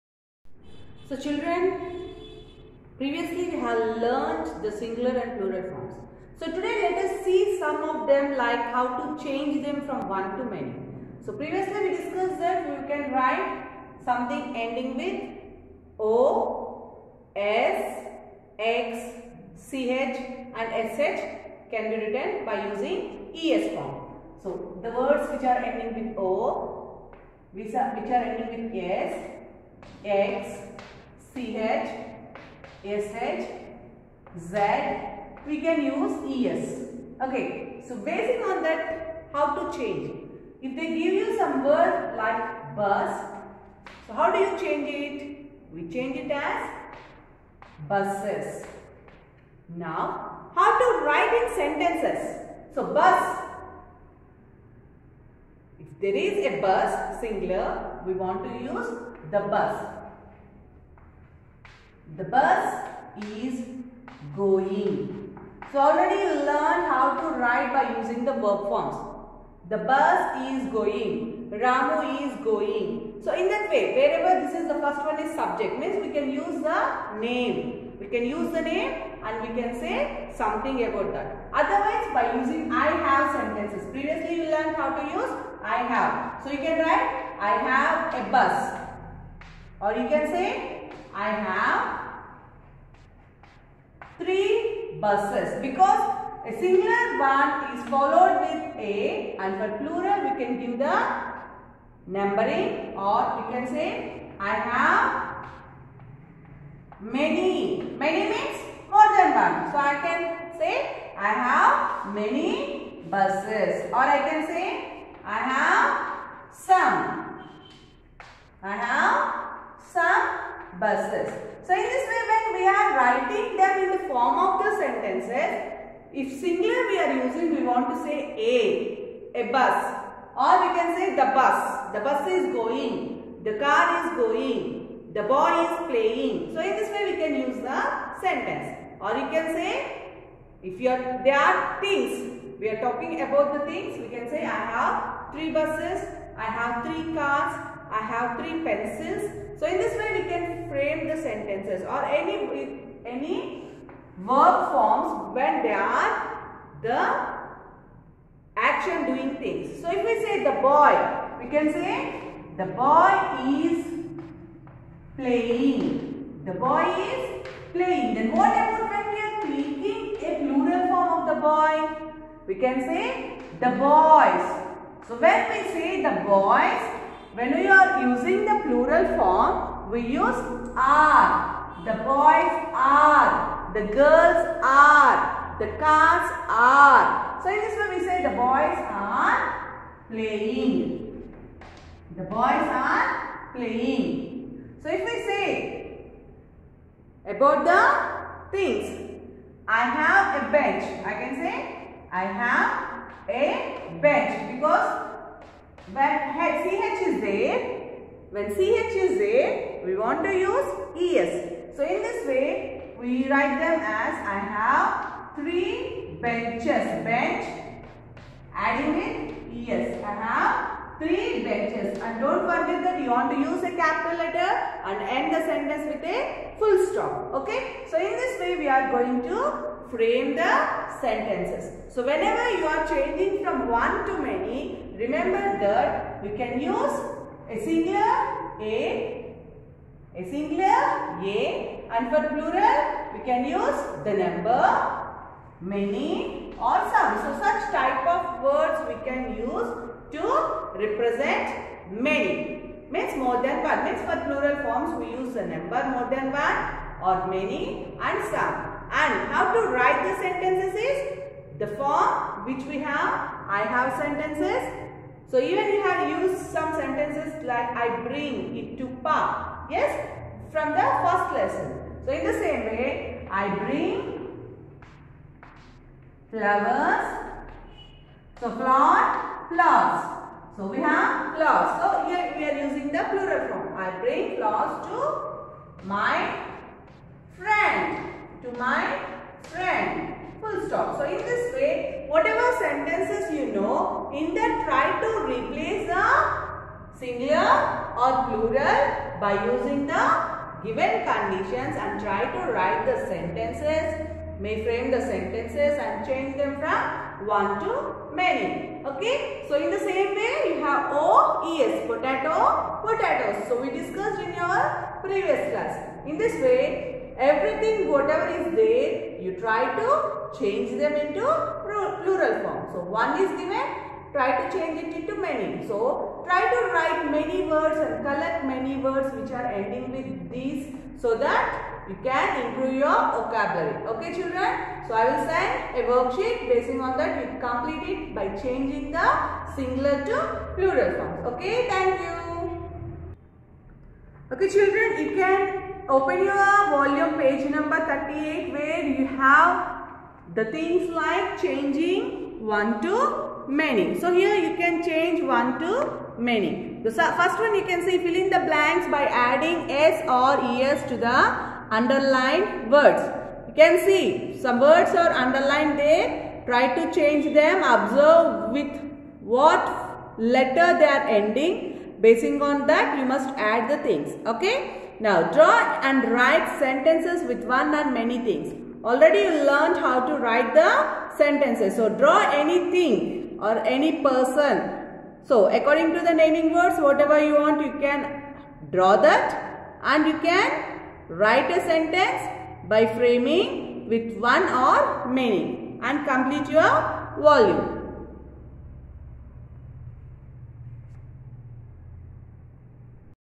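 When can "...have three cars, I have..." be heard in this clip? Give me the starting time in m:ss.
2:26.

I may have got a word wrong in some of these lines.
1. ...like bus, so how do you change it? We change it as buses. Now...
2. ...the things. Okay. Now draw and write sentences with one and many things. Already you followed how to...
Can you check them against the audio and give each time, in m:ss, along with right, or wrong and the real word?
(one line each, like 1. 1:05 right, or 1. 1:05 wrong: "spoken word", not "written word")
1. 0:42 right
2. 6:13 wrong: "learned", not "followed".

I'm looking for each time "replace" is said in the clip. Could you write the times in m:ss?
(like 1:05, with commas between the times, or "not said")
4:55.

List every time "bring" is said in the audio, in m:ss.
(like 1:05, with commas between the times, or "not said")
4:28, 4:33, 4:43.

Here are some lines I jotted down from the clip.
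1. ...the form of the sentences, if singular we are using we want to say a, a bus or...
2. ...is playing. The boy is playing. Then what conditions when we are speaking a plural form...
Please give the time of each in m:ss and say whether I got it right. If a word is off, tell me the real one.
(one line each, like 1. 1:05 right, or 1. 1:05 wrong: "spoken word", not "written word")
1. 2:03 right
2. 2:43 wrong: "happens", not "conditions".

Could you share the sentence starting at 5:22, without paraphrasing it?
So, one is given, try to change it into many.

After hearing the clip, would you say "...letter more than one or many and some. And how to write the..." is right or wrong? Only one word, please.
wrong.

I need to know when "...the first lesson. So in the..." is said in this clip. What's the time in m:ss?
4:30.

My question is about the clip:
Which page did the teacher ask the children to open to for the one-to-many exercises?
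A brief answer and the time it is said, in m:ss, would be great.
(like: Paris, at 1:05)
38, at 5:47.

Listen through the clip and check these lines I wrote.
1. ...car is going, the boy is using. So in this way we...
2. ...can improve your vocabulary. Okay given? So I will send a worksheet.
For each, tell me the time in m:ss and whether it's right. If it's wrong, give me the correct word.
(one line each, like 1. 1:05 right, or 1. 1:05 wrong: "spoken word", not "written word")
1. 2:13 wrong: "playing", not "using"
2. 5:32 wrong: "children", not "given".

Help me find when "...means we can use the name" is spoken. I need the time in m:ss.
1:15.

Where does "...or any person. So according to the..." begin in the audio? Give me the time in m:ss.
6:23.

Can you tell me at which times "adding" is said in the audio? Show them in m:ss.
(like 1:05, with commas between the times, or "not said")
3:38, 5:59.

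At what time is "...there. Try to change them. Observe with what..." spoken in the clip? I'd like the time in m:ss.
6:05.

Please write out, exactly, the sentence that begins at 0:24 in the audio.
So the words which are ending with O, which are ending with S, X, CH, SH, Z, we can use ES.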